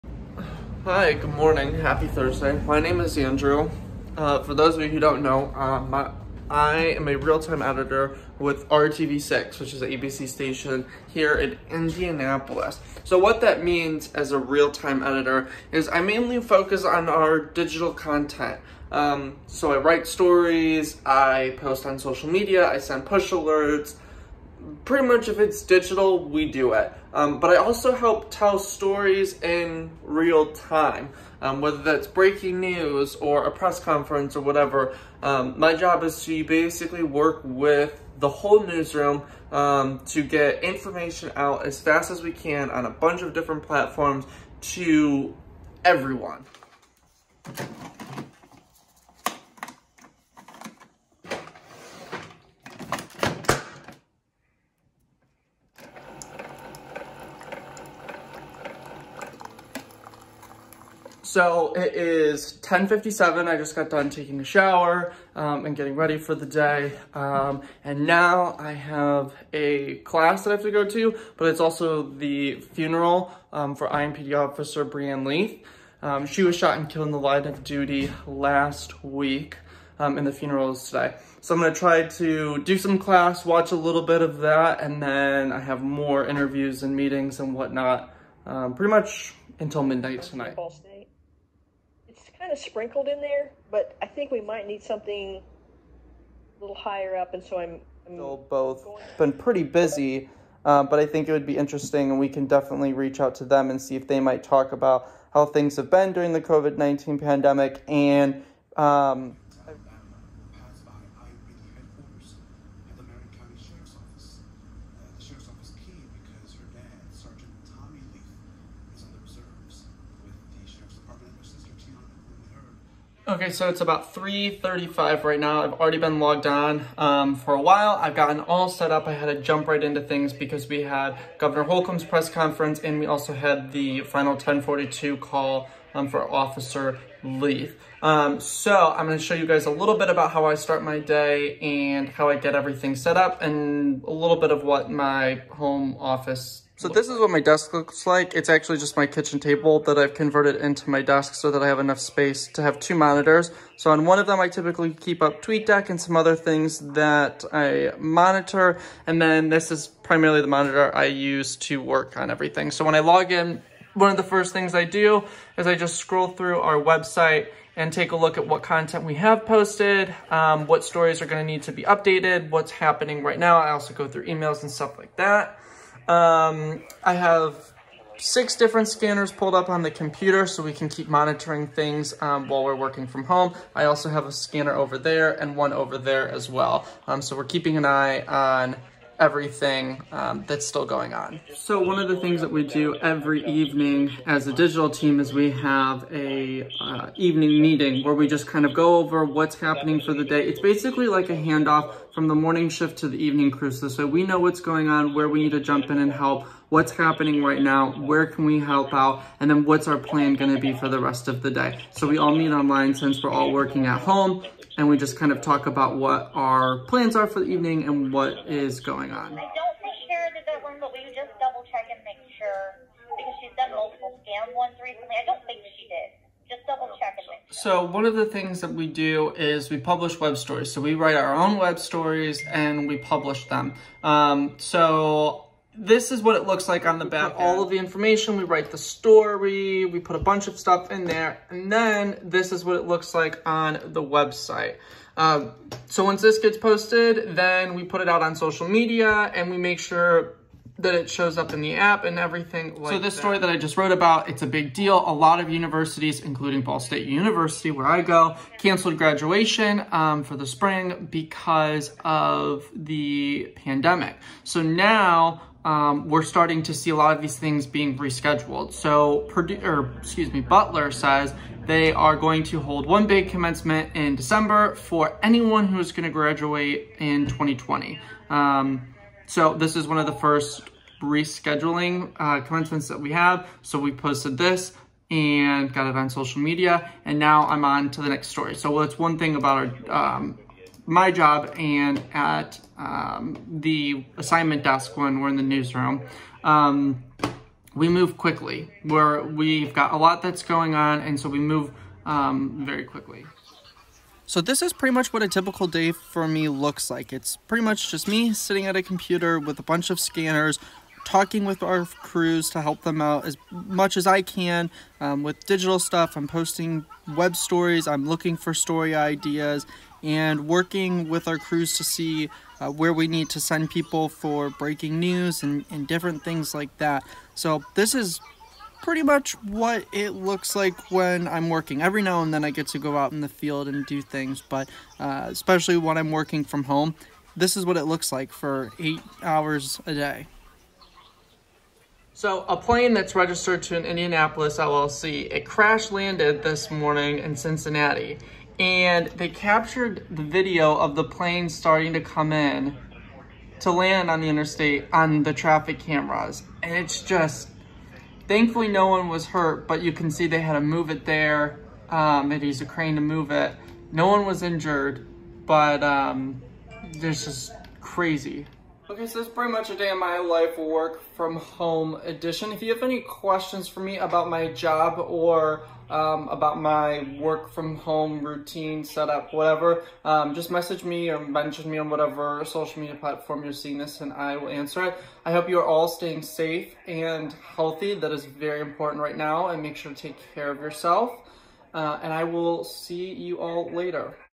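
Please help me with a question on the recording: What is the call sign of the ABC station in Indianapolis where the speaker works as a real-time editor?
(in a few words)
RTV6.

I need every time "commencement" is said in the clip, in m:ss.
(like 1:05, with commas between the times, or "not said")
4:33, 4:42.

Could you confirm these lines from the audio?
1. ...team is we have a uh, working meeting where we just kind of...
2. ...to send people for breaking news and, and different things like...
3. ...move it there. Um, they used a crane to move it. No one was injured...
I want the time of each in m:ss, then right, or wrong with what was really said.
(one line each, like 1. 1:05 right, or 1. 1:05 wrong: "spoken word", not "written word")
1. 3:14 wrong: "evening", not "working"
2. 5:23 right
3. 6:00 right.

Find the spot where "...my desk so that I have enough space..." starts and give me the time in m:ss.
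2:30.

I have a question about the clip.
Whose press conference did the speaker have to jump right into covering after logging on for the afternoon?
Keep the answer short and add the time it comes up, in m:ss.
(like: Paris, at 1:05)
Governor Holcomb, at 2:11.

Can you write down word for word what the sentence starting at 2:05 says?
I've already been logged on um, for a while.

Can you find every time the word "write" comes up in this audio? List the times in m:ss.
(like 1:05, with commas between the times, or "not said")
0:19, 3:50, 3:58.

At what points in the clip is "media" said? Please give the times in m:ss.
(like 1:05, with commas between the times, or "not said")
0:22, 4:08, 4:46, 6:22.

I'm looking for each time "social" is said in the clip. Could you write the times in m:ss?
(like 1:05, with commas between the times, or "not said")
0:21, 4:08, 4:46, 6:22.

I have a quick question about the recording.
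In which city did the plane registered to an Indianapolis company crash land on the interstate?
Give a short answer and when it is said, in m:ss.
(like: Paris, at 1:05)
Cincinnati, at 5:47.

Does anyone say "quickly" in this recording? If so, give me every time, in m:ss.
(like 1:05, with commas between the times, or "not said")
4:58, 5:02.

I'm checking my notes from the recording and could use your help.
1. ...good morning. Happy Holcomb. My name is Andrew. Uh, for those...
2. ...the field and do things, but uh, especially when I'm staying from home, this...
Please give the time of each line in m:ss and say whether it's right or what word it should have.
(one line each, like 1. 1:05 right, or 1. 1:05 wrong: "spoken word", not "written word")
1. 0:01 wrong: "Thursday", not "Holcomb"
2. 5:33 wrong: "working", not "staying".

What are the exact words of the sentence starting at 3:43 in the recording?
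Because she's done multiple scam ones recently.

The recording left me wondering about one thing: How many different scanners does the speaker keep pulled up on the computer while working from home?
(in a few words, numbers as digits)
6.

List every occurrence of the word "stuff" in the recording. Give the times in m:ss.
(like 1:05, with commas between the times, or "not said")
2:54, 4:00, 5:15.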